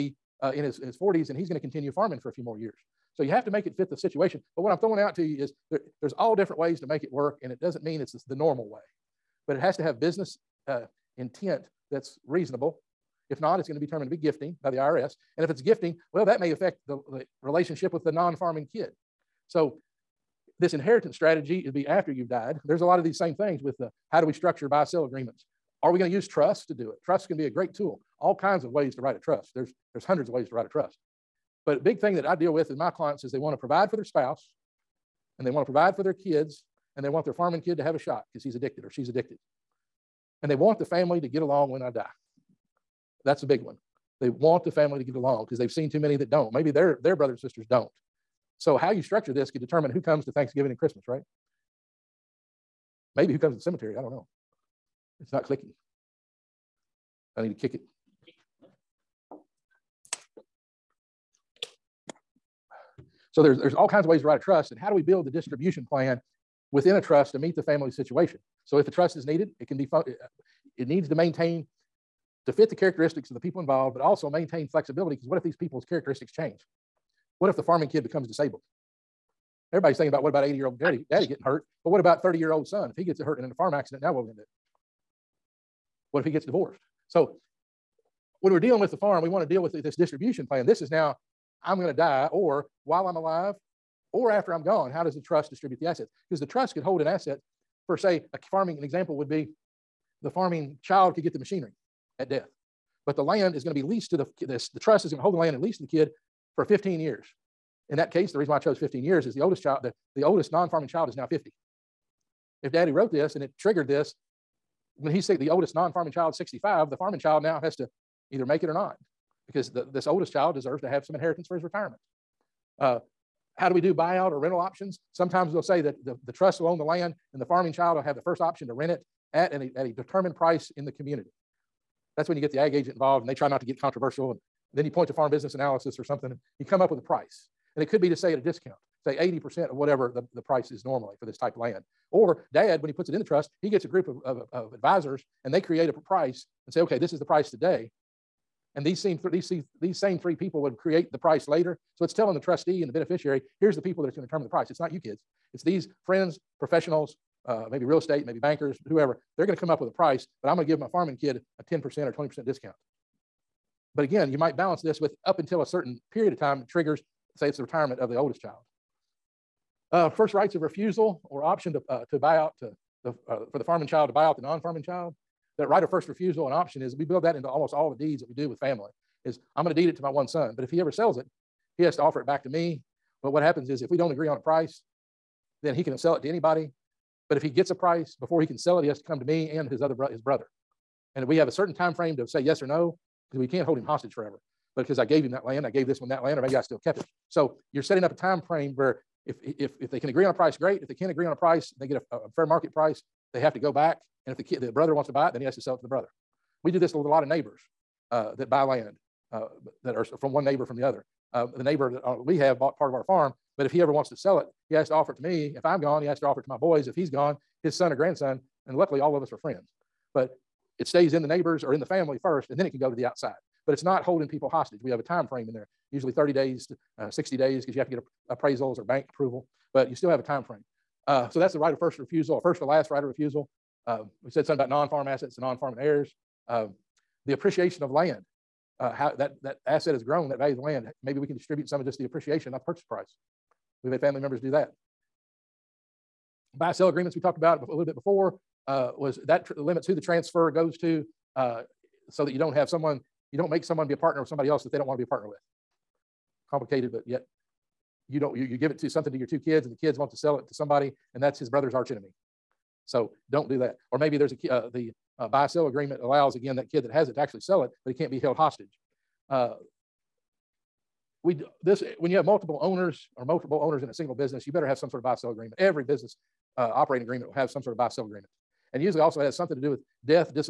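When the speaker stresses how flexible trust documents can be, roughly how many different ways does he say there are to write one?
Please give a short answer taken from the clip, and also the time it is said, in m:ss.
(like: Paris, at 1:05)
hundreds, at 0:30.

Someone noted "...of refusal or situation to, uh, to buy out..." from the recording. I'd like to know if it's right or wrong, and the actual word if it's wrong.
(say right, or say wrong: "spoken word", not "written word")
wrong: "option", not "situation".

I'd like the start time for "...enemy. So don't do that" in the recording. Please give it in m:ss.
4:21.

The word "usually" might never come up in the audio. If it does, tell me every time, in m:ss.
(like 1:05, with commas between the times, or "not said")
3:45, 4:38.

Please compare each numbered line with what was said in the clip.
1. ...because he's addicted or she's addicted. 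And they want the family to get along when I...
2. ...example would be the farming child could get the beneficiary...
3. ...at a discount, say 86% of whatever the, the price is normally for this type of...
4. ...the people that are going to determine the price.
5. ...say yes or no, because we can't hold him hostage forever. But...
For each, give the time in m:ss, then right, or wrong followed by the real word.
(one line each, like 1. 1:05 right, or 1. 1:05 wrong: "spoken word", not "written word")
1. 0:38 right
2. 1:38 wrong: "machinery", not "beneficiary"
3. 2:18 wrong: "80", not "86"
4. 2:33 right
5. 3:12 right.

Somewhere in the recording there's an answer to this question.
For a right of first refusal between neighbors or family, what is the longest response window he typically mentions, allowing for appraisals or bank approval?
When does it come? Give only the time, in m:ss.
3:47.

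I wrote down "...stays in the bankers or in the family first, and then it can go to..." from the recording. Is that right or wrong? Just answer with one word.
wrong.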